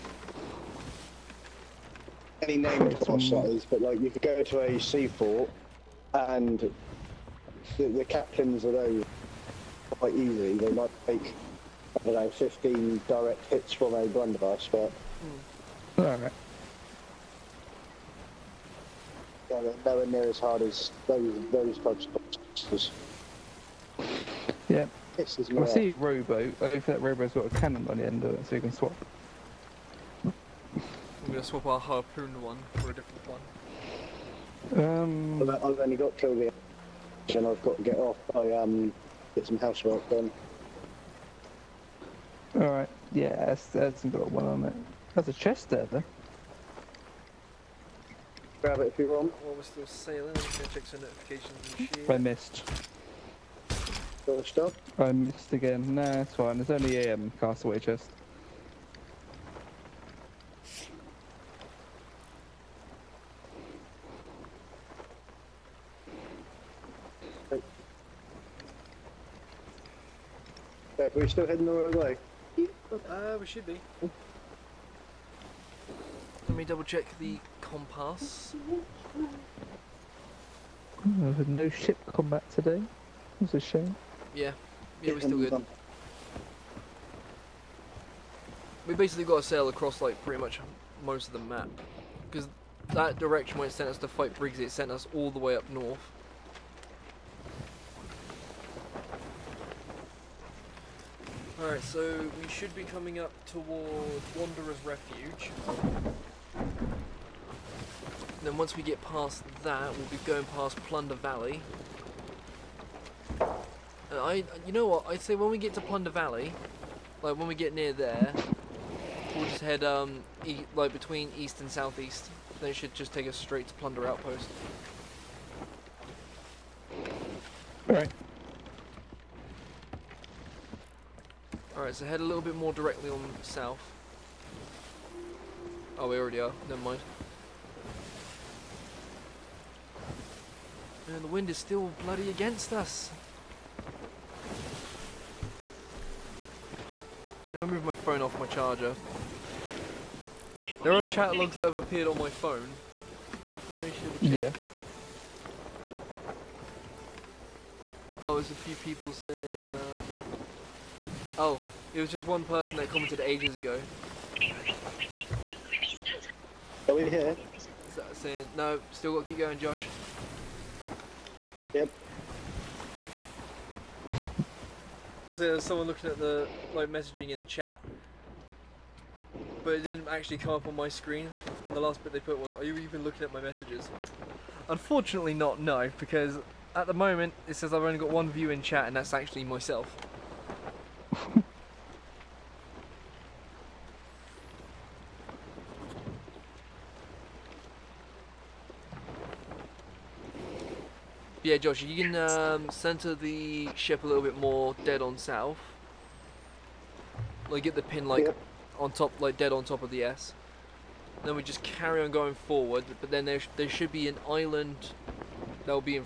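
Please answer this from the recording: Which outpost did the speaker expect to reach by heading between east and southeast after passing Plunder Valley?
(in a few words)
Plunder Outpost.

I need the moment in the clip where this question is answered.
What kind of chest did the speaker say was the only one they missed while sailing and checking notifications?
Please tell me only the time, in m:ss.
0:57.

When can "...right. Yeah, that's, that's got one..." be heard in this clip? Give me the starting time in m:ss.
0:42.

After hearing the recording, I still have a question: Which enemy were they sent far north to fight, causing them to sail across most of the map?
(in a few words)
Briggs.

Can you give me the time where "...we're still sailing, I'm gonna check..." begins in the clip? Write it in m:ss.
0:49.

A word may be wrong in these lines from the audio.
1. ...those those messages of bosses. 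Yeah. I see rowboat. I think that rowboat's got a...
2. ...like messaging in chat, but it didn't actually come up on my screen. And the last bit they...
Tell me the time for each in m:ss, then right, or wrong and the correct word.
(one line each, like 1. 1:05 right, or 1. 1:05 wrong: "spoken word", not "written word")
1. 0:21 wrong: "types", not "messages"
2. 2:56 right.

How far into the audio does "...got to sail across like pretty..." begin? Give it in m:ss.
1:29.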